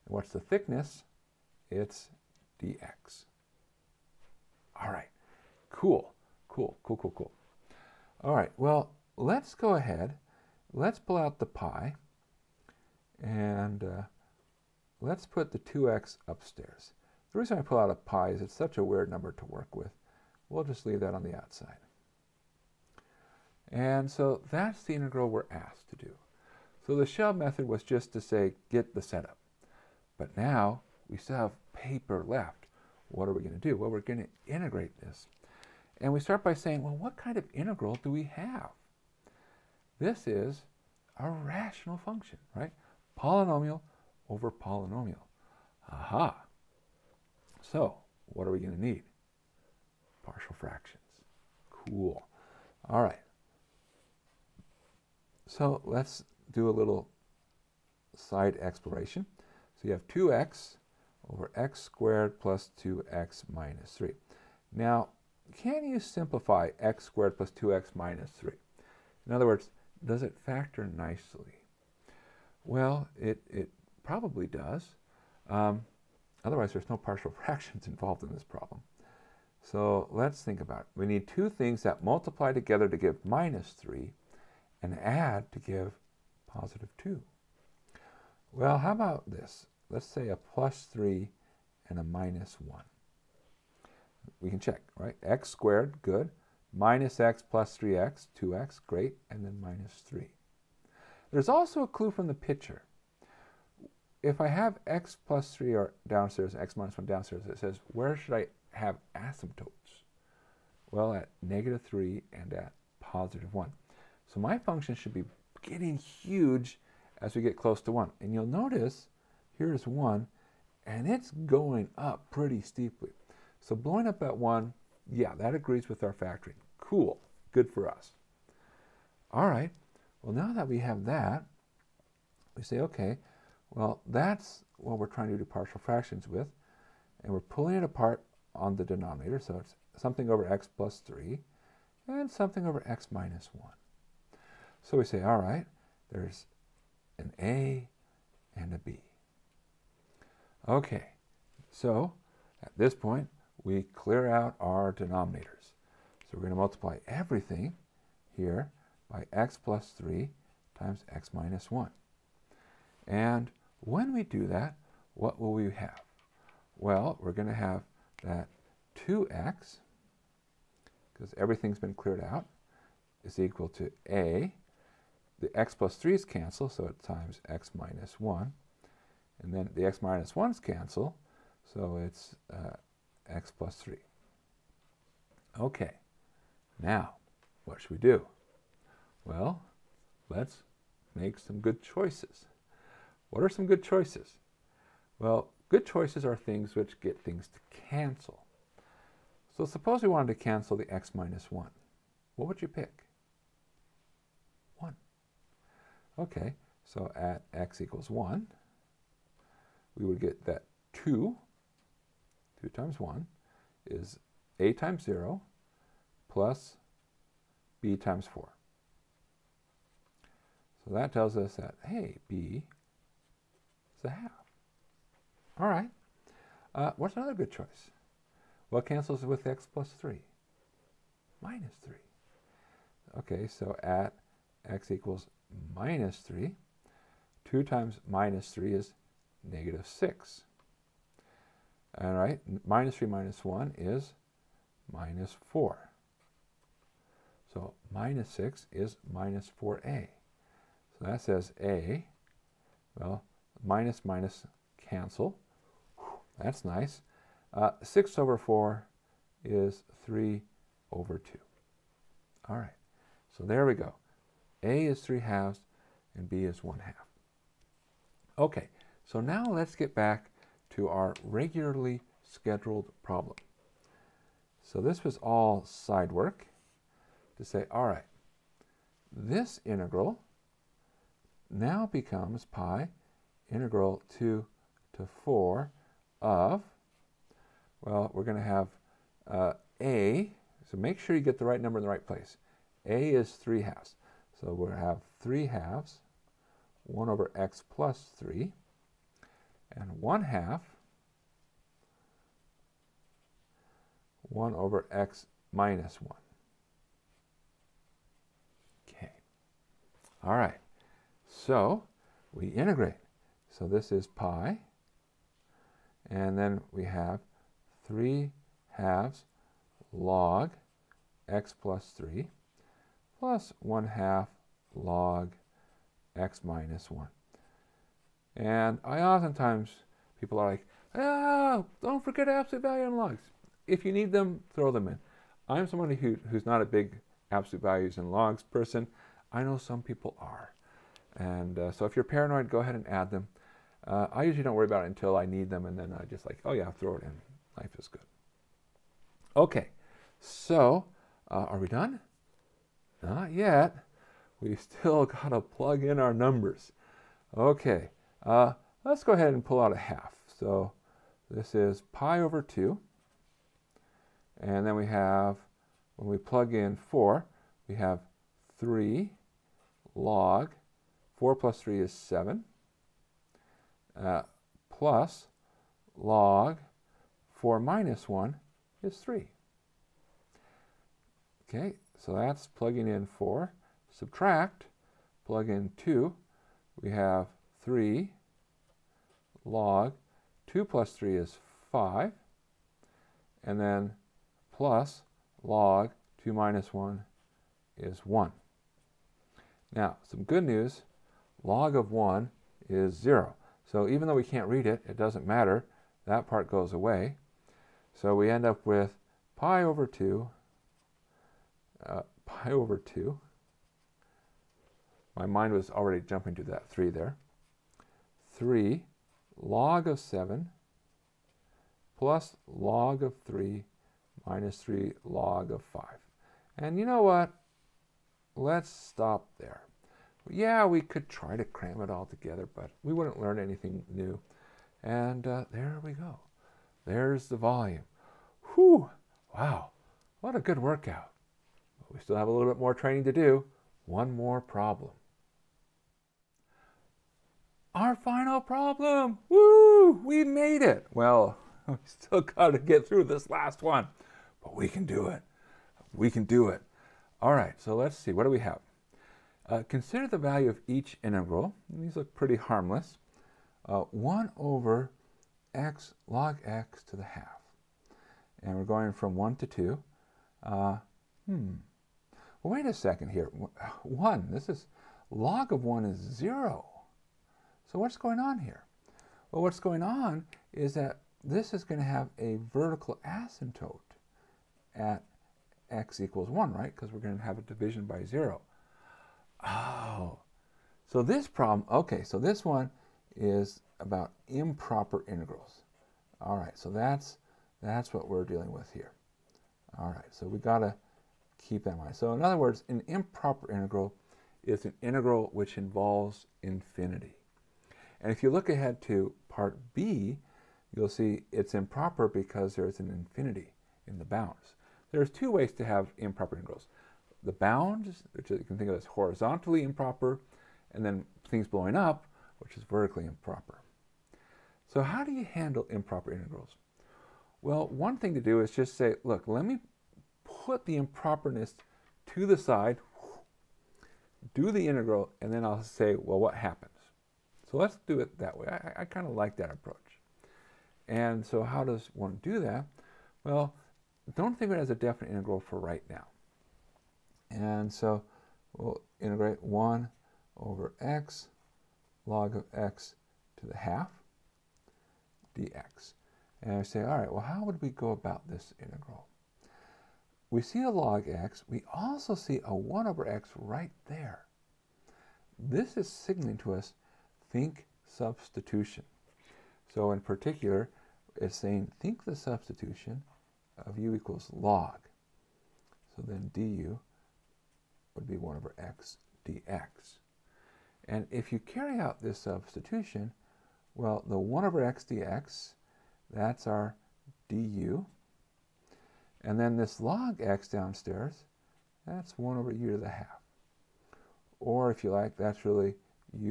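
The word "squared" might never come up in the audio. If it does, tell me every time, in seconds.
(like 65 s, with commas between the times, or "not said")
61 s, 67 s, 95 s.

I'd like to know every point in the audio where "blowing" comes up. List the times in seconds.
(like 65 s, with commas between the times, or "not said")
123 s, 521 s.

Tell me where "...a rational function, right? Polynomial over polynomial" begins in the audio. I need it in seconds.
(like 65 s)
41 s.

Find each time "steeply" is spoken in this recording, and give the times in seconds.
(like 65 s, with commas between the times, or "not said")
122 s.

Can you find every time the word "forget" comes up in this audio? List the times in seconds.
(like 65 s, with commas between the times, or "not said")
332 s.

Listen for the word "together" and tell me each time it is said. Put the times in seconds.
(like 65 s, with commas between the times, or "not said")
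82 s, 432 s.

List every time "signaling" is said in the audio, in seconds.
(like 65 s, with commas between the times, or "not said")
565 s.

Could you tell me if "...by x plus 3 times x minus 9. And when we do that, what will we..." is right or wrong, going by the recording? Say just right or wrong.
wrong.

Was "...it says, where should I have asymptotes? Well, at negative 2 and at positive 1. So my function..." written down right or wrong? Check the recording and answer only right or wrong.
wrong.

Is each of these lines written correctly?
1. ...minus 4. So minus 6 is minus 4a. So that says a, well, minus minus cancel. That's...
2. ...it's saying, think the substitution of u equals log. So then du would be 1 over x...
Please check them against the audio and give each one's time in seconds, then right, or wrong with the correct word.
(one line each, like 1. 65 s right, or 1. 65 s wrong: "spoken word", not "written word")
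1. 244 s right
2. 571 s right.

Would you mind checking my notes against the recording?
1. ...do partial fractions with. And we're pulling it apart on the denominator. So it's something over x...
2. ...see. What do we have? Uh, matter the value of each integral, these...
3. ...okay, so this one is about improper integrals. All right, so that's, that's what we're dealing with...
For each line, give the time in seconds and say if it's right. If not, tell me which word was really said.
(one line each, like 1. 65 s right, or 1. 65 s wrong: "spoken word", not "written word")
1. 135 s right
2. 457 s wrong: "consider", not "matter"
3. 491 s right.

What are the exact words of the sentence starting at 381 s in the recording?
Okay, so that's plugging in 4.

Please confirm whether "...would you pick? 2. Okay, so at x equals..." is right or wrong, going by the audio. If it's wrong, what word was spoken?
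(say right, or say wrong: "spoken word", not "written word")
wrong: "1", not "2".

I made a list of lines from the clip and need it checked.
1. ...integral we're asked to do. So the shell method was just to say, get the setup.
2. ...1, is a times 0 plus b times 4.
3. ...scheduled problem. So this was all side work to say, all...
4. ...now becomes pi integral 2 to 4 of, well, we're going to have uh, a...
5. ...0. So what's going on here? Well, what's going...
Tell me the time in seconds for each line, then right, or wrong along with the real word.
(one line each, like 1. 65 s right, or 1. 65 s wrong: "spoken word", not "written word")
1. 24 s right
2. 212 s right
3. 272 s right
4. 281 s right
5. 475 s right.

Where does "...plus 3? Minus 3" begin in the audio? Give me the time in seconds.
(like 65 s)
229 s.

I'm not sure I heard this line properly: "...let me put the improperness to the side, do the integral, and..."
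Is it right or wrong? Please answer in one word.
right.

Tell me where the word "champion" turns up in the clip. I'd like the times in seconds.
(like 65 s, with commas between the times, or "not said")
not said.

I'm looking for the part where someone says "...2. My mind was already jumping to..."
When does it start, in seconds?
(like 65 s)
412 s.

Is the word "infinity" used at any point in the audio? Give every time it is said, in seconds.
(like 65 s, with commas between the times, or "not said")
506 s, 512 s.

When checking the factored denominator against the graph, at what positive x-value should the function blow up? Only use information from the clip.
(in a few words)
1.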